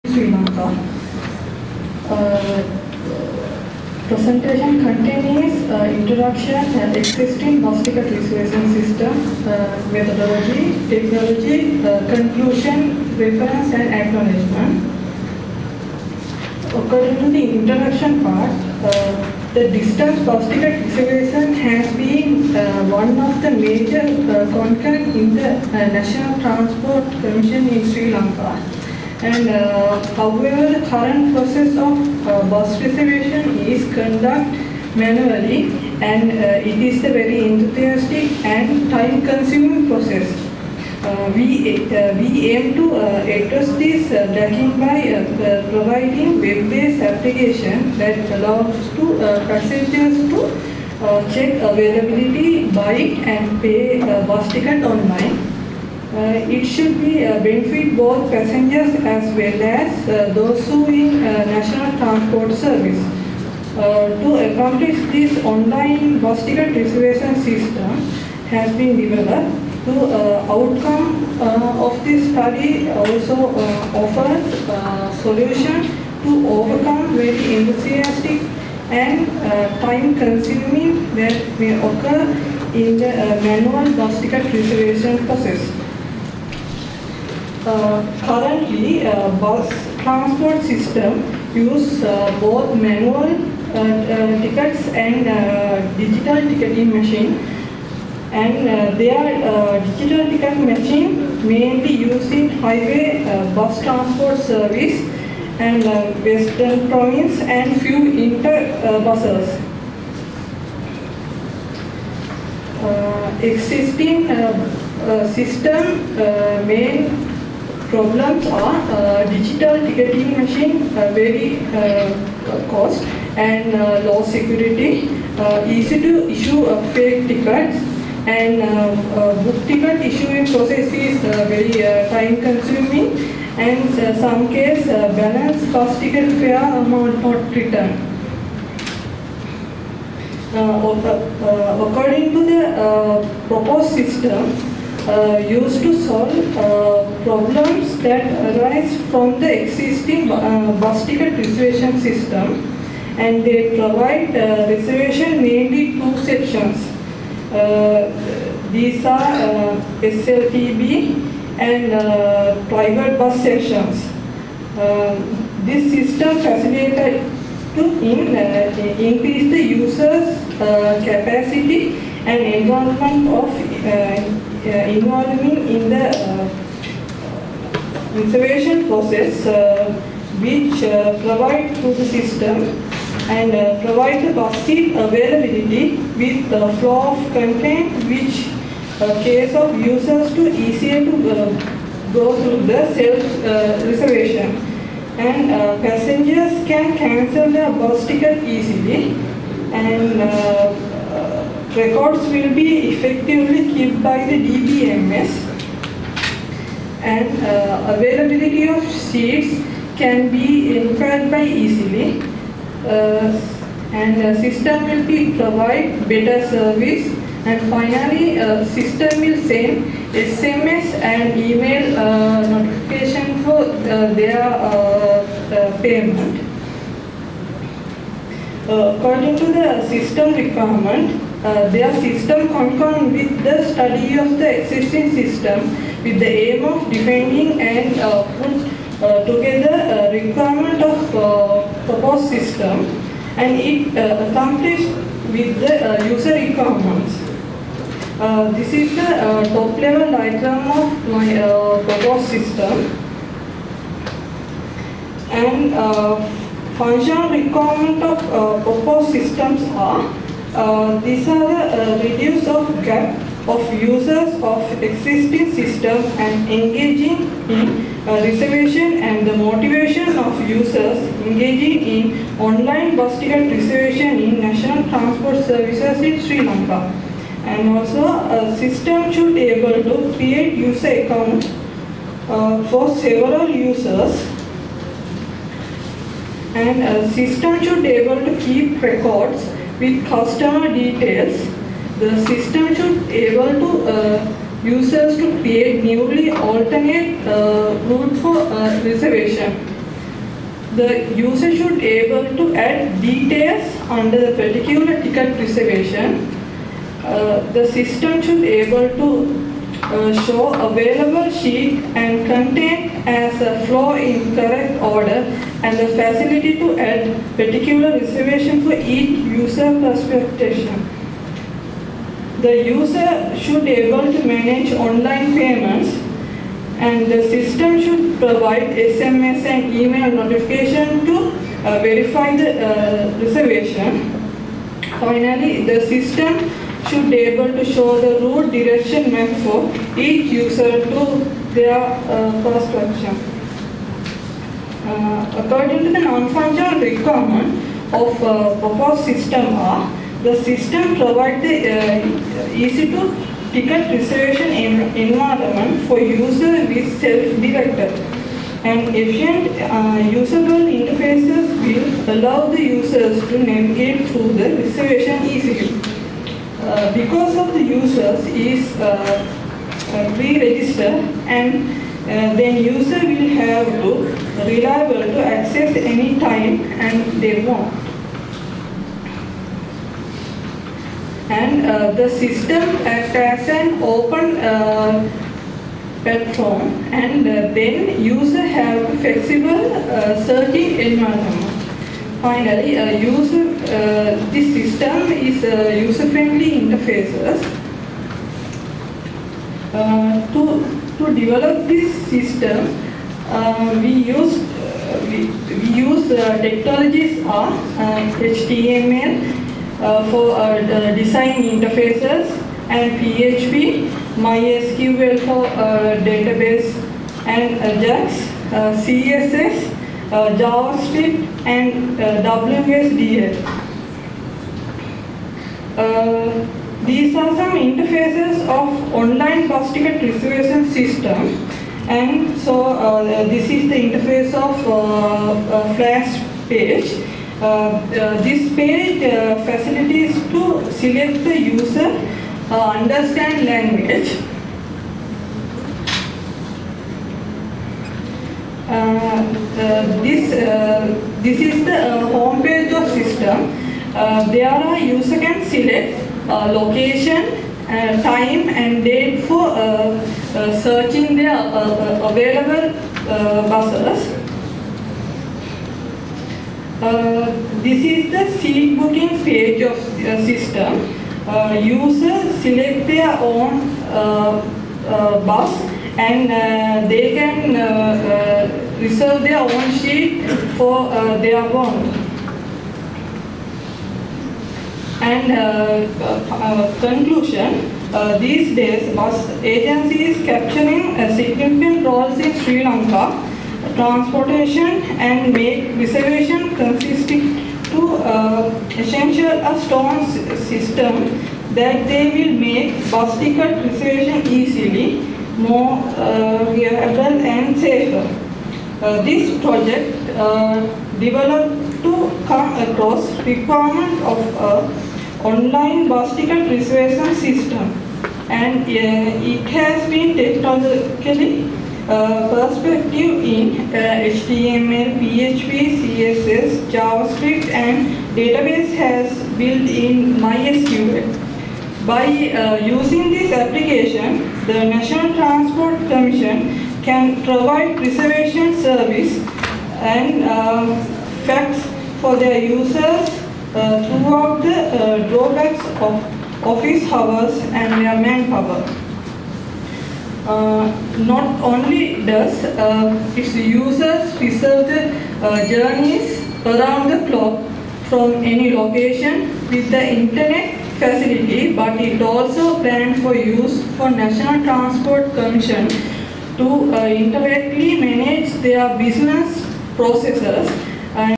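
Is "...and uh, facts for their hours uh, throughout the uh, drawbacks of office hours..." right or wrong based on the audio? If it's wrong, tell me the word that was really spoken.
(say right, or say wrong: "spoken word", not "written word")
wrong: "users", not "hours".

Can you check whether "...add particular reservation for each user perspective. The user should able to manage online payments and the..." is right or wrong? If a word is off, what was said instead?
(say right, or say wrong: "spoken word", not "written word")
right.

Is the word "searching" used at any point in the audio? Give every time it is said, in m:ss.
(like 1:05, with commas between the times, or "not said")
6:30, 7:40.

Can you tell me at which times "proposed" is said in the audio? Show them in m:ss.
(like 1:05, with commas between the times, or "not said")
2:23, 4:01, 4:11, 4:18, 5:48.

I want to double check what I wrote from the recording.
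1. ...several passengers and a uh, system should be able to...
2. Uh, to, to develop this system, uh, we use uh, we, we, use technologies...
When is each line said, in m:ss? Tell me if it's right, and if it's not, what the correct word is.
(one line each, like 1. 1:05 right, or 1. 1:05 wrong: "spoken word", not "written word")
1. 4:42 wrong: "users", not "passengers"
2. 6:39 right.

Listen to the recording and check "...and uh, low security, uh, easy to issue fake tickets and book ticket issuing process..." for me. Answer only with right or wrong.
right.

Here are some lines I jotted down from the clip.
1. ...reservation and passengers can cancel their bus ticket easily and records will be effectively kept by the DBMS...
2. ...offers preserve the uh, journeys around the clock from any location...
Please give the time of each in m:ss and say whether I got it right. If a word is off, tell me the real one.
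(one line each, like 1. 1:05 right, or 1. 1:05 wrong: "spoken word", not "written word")
1. 3:13 right
2. 9:13 wrong: "users", not "offers".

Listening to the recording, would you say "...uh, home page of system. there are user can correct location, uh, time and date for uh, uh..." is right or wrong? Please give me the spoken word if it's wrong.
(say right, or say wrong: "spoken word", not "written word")
wrong: "select", not "correct".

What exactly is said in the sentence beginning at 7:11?
And so uh, this is the interface of uh, Flash page.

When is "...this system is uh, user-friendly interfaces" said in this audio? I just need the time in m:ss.
6:34.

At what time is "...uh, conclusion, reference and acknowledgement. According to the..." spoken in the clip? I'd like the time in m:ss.
0:11.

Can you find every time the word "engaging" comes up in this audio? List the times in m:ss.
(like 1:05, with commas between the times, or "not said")
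4:26, 4:31.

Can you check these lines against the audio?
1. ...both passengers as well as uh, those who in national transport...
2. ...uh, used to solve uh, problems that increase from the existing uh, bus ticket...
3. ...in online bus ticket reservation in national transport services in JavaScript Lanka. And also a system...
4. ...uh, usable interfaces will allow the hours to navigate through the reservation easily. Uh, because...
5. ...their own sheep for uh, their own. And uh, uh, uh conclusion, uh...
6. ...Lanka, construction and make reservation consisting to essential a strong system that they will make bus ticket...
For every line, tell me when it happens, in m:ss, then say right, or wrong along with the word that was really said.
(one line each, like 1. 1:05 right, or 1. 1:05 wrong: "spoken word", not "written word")
1. 0:57 right
2. 2:25 wrong: "arise", not "increase"
3. 4:31 wrong: "Sri", not "JavaScript"
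4. 5:59 wrong: "users", not "hours"
5. 7:59 right
6. 8:12 wrong: "transportation", not "construction".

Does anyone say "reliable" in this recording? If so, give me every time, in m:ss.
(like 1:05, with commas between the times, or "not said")
6:14, 8:26.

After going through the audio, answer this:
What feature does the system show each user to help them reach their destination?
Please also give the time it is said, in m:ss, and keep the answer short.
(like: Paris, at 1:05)
route direction map, at 5:38.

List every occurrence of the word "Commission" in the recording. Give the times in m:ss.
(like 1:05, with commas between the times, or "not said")
0:27, 9:25.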